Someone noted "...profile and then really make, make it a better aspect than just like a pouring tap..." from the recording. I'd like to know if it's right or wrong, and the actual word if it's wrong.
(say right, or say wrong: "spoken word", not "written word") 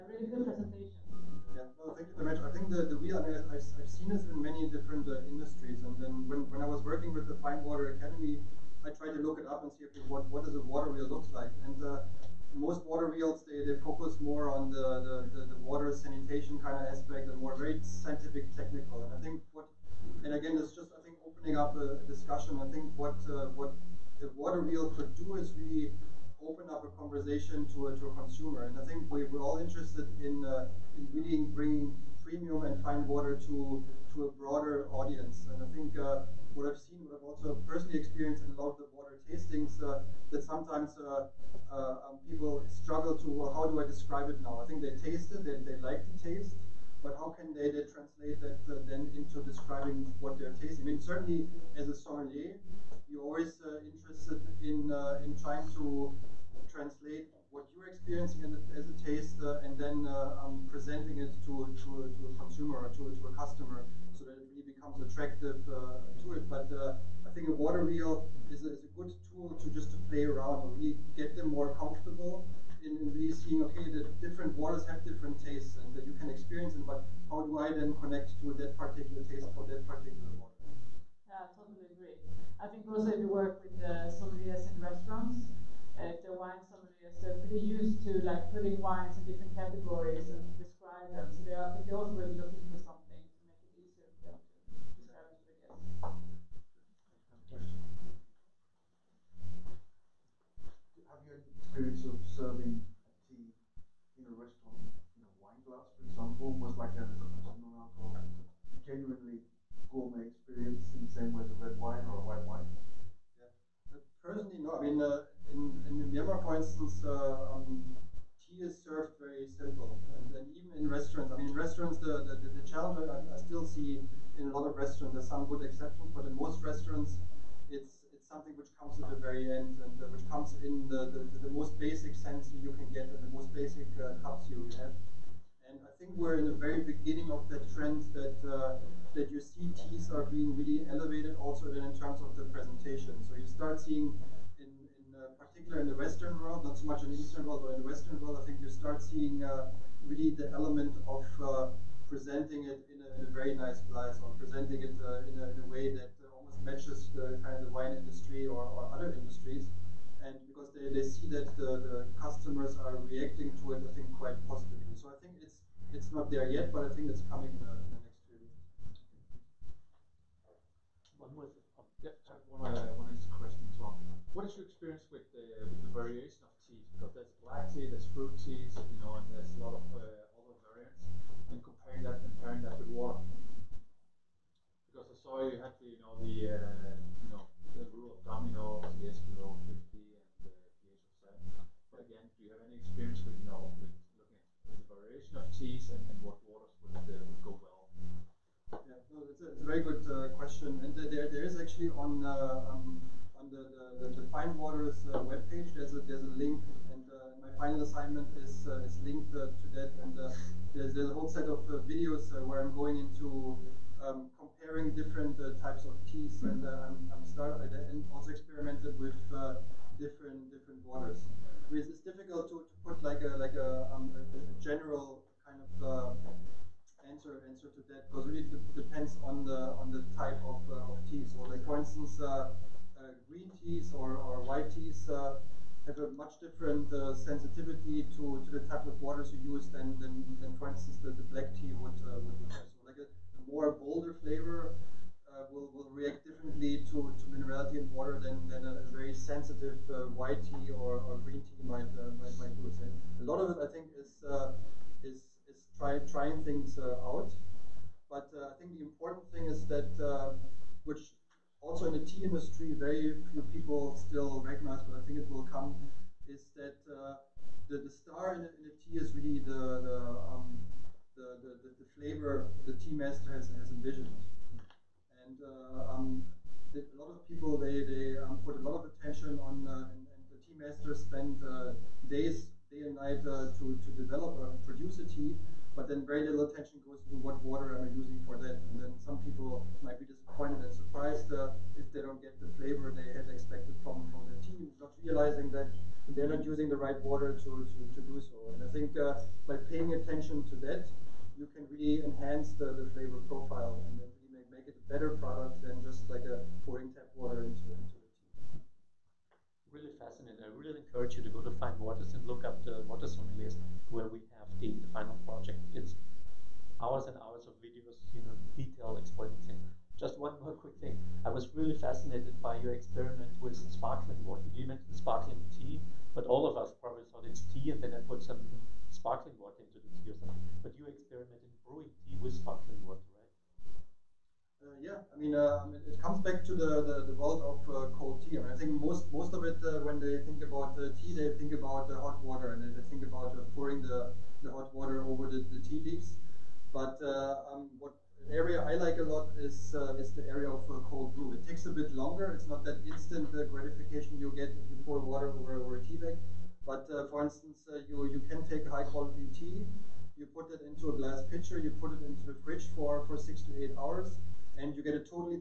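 wrong: "product", not "aspect".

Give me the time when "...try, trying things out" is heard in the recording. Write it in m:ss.
4:15.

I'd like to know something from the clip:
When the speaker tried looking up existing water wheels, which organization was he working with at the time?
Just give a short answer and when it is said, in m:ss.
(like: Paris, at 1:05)
Fine Water Academy, at 0:07.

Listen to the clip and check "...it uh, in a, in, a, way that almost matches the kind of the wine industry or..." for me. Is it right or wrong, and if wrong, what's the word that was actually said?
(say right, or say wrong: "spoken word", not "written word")
right.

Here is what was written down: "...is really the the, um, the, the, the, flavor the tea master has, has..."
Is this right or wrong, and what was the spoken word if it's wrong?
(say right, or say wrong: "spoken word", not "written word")
right.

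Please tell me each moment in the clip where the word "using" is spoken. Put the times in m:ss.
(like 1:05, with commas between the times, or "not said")
4:47, 4:56.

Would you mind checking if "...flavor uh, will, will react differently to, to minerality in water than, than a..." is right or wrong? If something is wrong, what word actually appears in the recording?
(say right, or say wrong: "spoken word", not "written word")
right.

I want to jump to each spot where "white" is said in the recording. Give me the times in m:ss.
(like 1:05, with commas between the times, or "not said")
3:54, 4:10.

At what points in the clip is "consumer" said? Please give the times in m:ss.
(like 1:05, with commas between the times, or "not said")
0:28, 1:02.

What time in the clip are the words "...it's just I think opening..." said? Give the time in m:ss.
0:20.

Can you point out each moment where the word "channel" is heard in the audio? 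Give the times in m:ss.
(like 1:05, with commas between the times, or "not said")
not said.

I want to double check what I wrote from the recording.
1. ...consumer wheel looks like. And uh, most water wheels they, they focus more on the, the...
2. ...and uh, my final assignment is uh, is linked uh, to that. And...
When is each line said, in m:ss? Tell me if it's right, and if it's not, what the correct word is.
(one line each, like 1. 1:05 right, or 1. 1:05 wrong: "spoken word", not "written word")
1. 0:10 wrong: "water", not "consumer"
2. 3:26 right.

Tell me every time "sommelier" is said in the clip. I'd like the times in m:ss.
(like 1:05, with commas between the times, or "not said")
0:51, 5:13.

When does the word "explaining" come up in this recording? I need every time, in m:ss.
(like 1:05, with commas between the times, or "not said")
5:18.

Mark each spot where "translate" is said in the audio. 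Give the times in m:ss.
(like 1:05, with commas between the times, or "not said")
0:47, 0:56.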